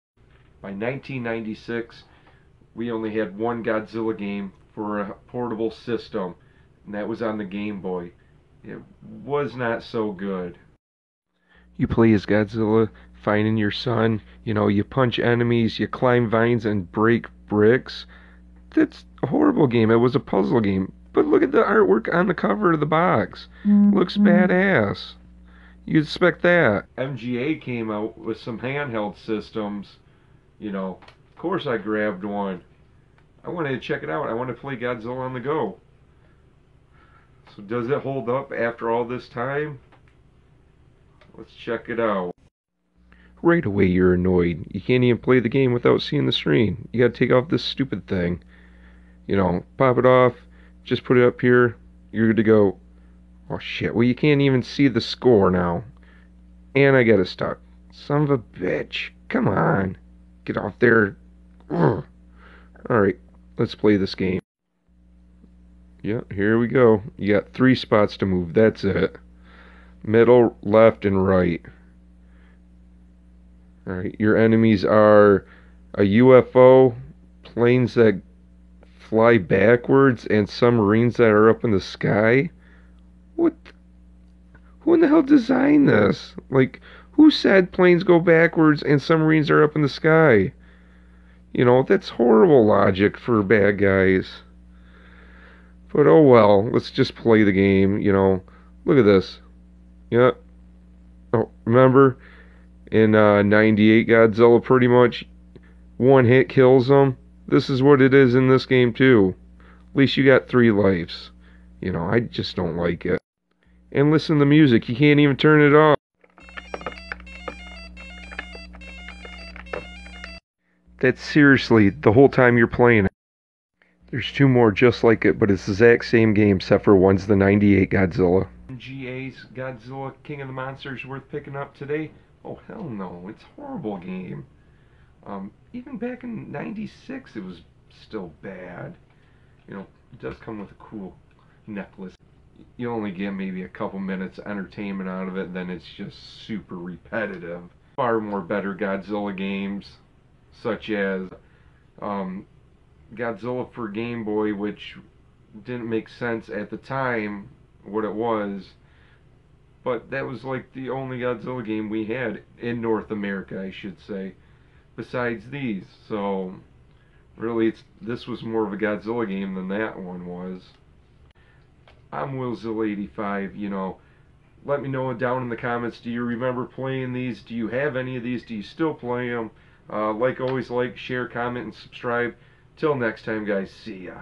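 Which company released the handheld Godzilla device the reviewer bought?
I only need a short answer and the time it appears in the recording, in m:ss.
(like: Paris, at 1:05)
MGA, at 0:26.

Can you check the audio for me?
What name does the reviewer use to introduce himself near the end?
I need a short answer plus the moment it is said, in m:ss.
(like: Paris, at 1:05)
Willzilla85, at 2:52.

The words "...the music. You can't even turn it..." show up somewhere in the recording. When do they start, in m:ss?
1:54.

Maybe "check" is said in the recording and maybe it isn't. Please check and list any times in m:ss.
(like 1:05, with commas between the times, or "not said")
0:33, 0:41.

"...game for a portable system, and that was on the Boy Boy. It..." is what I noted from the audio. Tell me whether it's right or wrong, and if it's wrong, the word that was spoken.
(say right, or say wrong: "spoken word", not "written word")
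wrong: "Game", not "Boy".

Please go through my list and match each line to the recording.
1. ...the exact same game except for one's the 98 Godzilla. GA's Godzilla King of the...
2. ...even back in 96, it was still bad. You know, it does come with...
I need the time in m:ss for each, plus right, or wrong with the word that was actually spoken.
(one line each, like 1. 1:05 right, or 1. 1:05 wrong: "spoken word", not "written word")
1. 2:05 right
2. 2:15 right.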